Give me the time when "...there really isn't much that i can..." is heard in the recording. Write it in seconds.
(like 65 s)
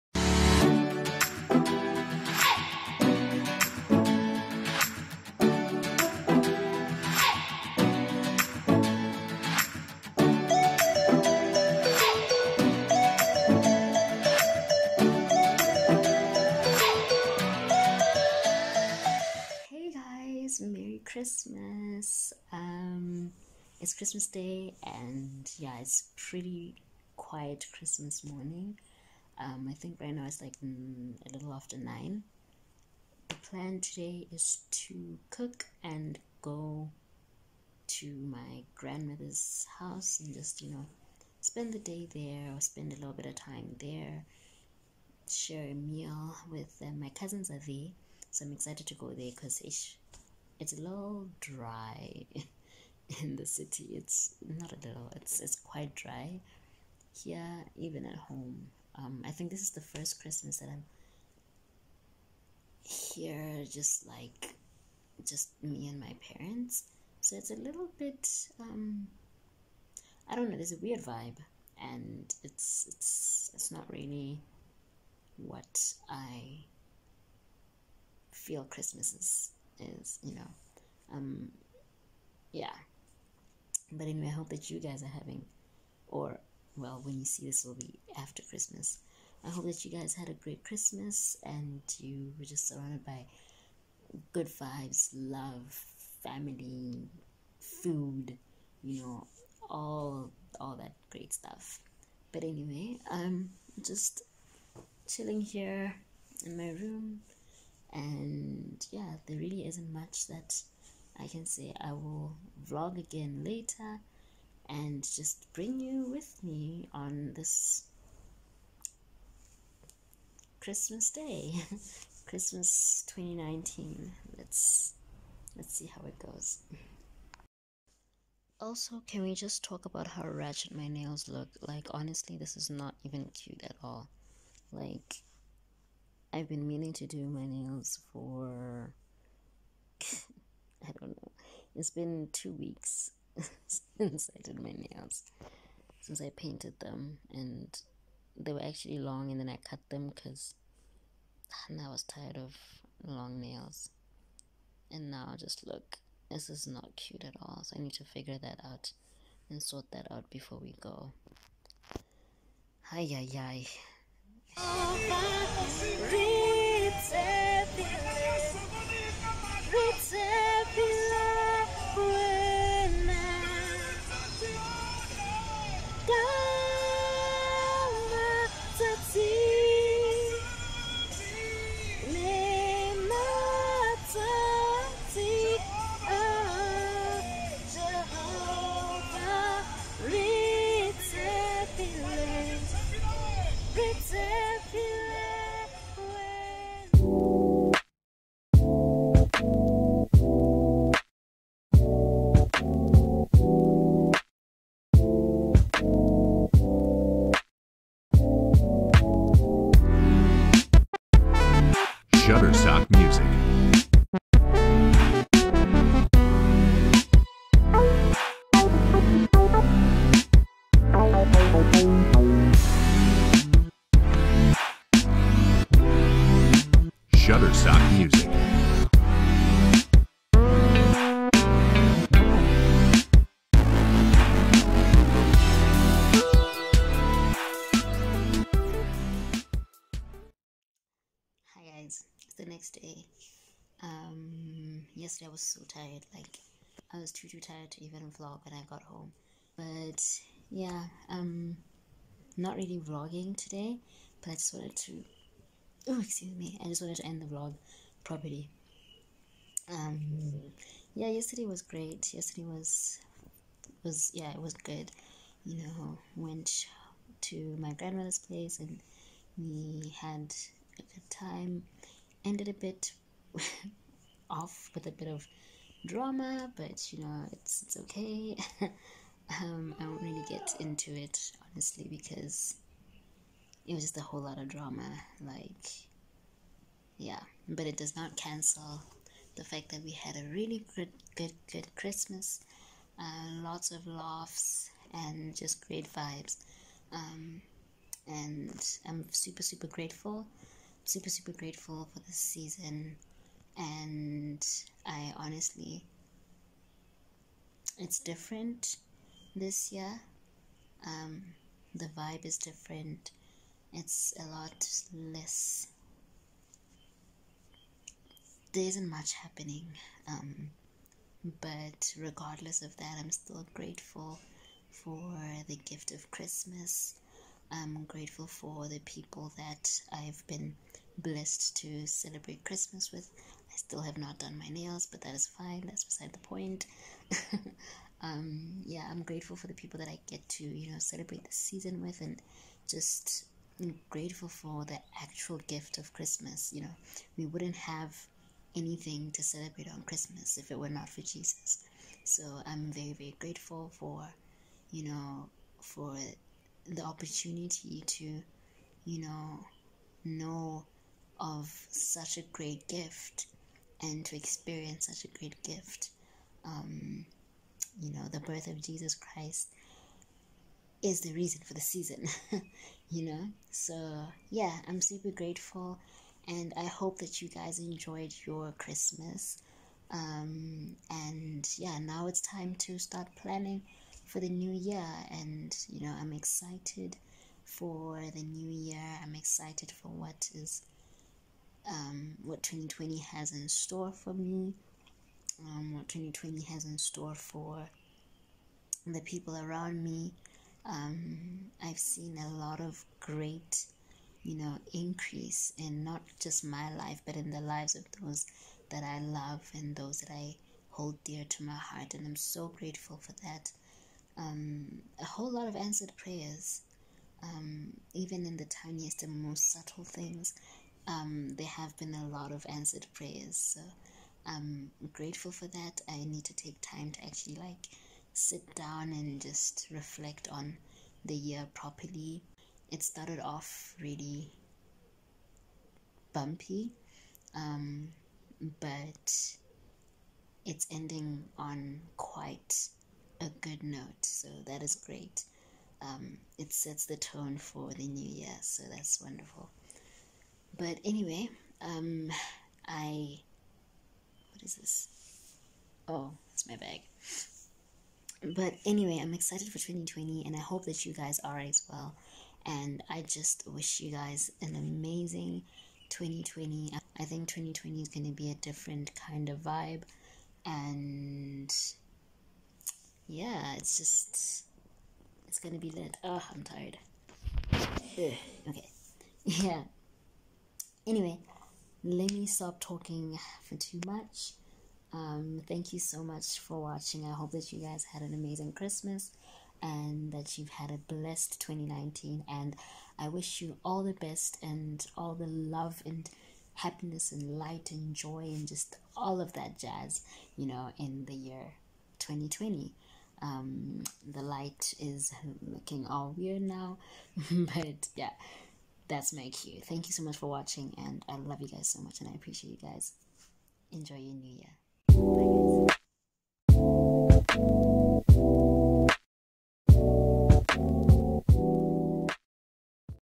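109 s.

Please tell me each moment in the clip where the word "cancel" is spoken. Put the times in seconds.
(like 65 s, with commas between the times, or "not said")
288 s.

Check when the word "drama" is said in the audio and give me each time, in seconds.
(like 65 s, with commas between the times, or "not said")
275 s, 284 s.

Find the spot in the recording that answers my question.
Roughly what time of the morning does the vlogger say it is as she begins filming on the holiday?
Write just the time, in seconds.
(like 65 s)
31 s.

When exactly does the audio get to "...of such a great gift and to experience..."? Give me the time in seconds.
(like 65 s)
361 s.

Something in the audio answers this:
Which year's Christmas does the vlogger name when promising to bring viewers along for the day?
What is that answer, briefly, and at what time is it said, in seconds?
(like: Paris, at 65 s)
2019, at 122 s.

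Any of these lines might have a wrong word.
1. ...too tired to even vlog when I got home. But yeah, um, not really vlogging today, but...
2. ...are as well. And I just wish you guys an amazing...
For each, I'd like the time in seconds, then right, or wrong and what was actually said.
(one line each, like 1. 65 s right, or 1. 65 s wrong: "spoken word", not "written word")
1. 247 s right
2. 461 s right.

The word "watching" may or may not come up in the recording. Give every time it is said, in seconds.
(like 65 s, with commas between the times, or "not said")
486 s, 510 s.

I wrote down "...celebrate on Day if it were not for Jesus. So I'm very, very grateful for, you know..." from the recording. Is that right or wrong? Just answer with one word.
wrong.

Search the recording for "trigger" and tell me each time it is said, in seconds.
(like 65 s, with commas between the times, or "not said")
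not said.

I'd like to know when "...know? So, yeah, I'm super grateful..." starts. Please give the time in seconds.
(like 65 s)
373 s.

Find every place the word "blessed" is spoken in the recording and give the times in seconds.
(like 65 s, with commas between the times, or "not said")
330 s, 490 s.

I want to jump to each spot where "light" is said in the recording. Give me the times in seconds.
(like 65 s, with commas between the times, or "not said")
497 s, 504 s.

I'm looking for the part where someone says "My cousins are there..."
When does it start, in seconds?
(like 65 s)
47 s.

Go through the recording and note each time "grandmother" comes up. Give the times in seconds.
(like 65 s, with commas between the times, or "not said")
38 s, 267 s.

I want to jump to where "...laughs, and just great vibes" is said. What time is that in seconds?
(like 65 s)
293 s.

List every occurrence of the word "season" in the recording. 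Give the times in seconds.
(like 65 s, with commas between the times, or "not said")
302 s, 341 s, 371 s.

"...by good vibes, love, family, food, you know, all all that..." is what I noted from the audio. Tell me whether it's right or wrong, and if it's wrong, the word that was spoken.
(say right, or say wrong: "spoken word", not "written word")
right.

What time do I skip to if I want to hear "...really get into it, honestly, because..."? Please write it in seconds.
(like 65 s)
280 s.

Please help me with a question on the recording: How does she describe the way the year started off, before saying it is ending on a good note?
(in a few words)
Really bumpy.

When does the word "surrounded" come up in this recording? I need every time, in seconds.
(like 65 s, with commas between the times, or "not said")
92 s.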